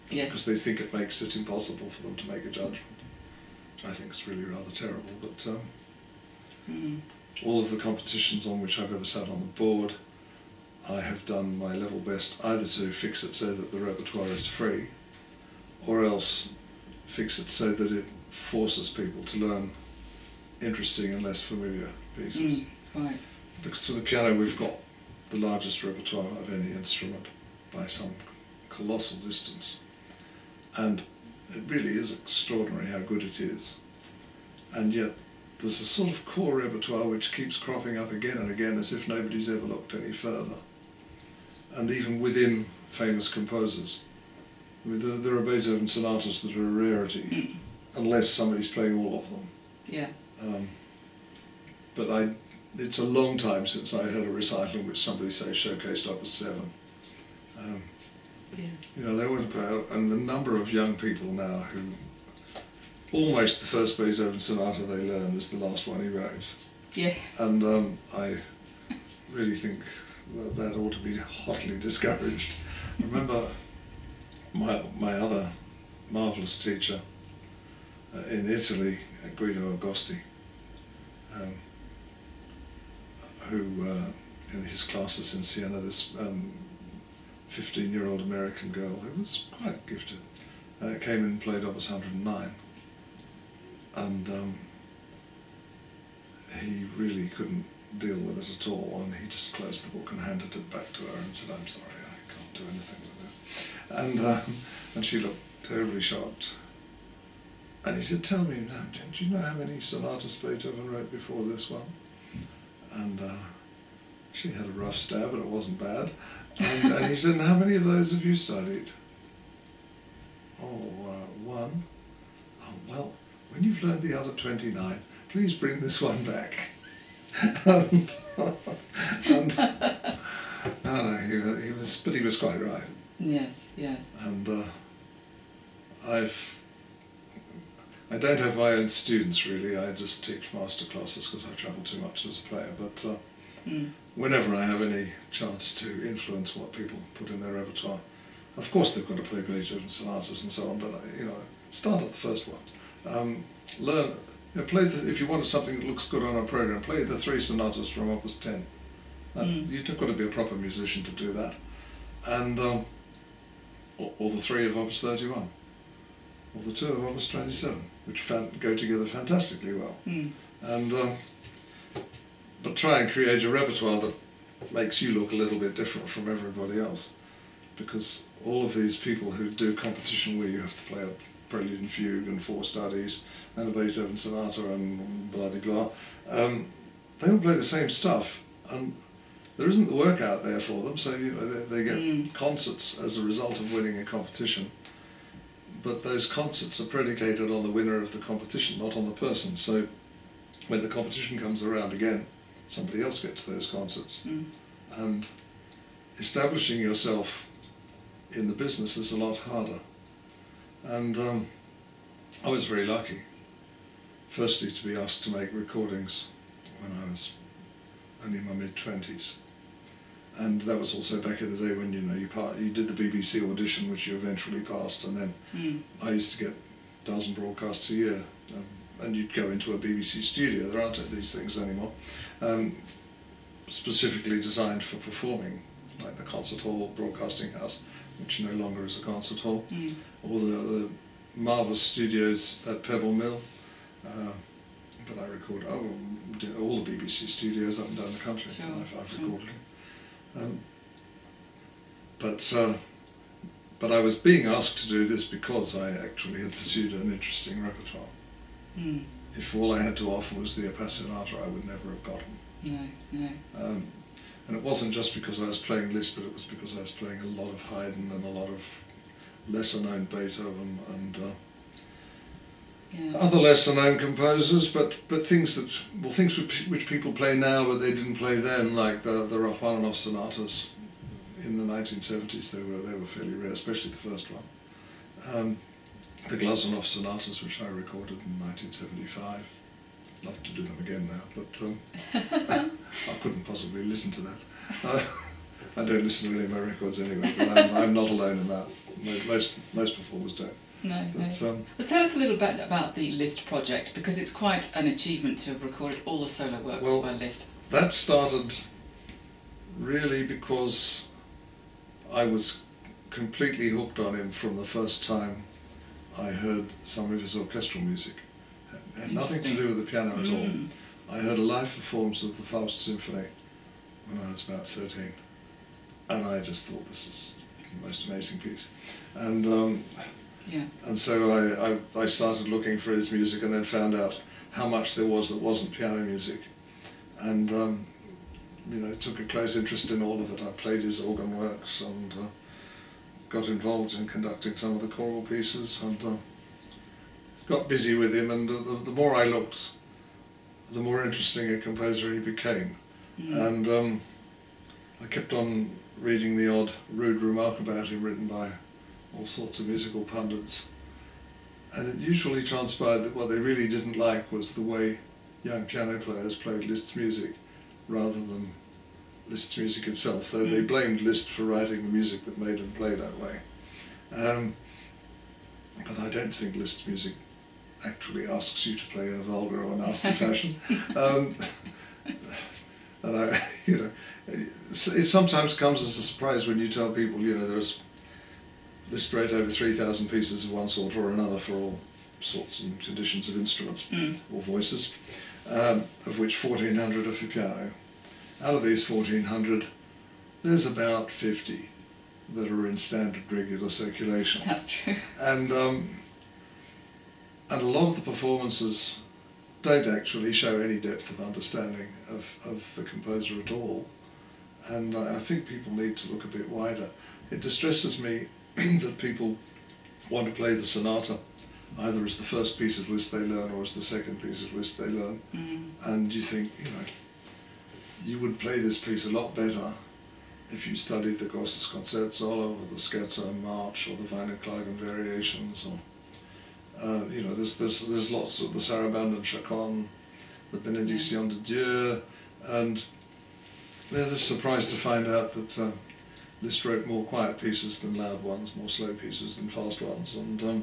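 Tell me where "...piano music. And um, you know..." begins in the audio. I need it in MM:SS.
05:35.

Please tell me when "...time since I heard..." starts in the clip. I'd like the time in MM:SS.
00:53.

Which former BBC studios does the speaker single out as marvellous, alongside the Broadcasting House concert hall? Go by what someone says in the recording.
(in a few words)
Pebble Mill.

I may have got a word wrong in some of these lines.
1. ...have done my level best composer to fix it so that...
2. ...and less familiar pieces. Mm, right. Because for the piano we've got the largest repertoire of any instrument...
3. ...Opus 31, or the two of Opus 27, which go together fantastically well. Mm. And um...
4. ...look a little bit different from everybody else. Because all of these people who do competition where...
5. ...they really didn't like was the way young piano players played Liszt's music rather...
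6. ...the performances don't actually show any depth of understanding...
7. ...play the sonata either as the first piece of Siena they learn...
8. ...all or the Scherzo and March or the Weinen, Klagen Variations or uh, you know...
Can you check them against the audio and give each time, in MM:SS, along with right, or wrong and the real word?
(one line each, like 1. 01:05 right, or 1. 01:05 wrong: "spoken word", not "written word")
1. 00:11 wrong: "either", not "composer"
2. 00:21 right
3. 02:44 right
4. 02:55 right
5. 06:03 right
6. 06:47 right
7. 07:00 wrong: "Liszt", not "Siena"
8. 07:12 right.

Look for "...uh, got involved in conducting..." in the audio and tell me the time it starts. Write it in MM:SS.
05:42.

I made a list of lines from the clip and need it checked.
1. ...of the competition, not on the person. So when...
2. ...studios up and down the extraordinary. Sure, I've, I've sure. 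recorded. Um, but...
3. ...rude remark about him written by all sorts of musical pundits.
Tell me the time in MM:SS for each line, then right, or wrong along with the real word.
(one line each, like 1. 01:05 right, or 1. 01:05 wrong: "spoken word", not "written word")
1. 03:18 right
2. 04:07 wrong: "country", not "extraordinary"
3. 05:56 right.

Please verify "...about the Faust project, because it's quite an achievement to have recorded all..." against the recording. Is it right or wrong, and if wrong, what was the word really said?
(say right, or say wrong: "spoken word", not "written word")
wrong: "Liszt", not "Faust".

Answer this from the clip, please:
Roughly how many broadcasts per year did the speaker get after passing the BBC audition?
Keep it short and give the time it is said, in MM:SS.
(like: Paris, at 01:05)
a dozen, at 03:46.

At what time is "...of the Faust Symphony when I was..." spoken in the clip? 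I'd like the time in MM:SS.
05:22.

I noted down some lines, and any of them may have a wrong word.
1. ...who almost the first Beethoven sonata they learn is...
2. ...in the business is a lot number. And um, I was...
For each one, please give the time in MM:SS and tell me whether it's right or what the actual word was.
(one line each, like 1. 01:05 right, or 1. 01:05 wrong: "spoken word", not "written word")
1. 01:01 right
2. 03:28 wrong: "harder", not "number".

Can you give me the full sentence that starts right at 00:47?
unless somebody's playing all of them.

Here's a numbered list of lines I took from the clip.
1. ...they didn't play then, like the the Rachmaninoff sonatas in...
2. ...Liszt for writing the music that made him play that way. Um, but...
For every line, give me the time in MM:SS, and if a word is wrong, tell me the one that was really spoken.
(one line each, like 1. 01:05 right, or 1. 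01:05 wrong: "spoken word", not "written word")
1. 04:37 right
2. 06:11 right.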